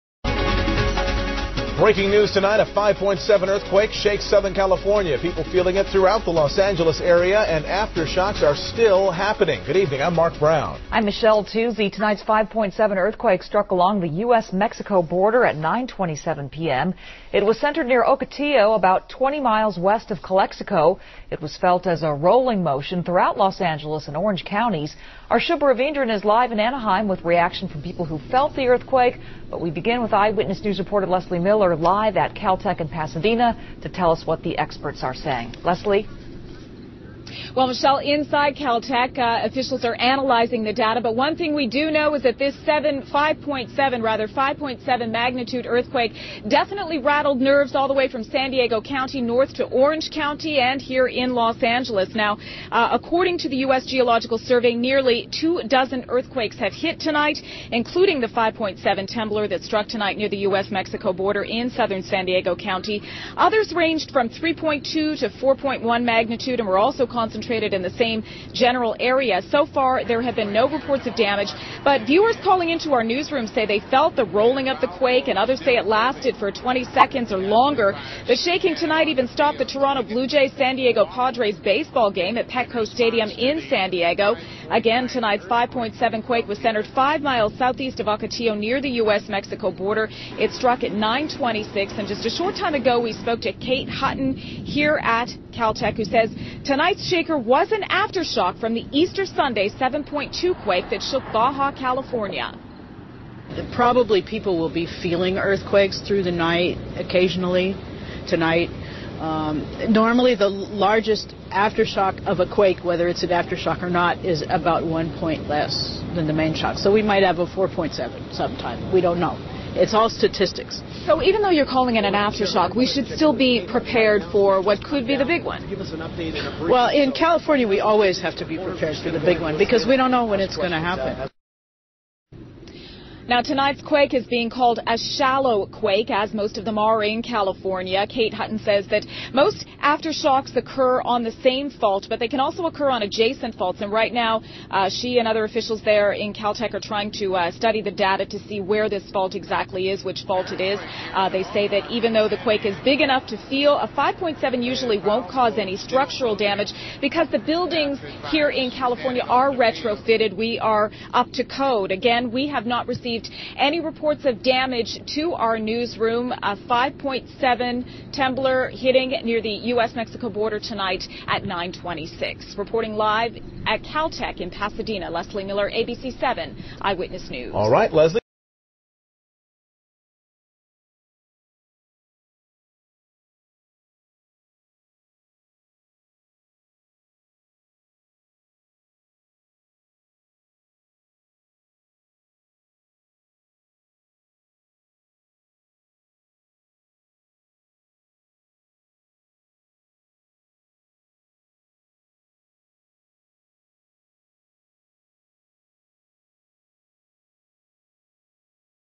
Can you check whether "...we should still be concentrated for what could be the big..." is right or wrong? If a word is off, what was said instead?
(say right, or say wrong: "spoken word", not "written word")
wrong: "prepared", not "concentrated".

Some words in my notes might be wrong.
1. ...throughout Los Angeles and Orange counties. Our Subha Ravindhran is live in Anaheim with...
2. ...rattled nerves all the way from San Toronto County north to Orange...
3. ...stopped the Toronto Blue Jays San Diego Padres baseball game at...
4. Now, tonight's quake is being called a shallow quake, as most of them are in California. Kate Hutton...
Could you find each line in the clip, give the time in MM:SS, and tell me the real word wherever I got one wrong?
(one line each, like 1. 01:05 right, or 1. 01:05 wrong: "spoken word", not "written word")
1. 00:23 right
2. 00:46 wrong: "Diego", not "Toronto"
3. 01:19 right
4. 02:13 right.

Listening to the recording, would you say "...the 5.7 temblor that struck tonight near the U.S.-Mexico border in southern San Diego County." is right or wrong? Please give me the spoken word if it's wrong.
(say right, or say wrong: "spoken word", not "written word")
right.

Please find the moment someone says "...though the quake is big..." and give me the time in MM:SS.
02:32.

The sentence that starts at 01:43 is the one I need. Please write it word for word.
Probably people will be feeling earthquakes through the night occasionally tonight.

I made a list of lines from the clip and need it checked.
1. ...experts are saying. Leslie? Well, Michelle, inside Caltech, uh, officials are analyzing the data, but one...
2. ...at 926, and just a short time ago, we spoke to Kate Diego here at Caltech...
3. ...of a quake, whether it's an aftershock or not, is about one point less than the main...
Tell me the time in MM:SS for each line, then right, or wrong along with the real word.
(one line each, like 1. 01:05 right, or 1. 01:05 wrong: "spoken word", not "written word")
1. 00:34 right
2. 01:30 wrong: "Hutton", not "Diego"
3. 01:52 right.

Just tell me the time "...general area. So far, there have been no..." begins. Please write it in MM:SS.
01:08.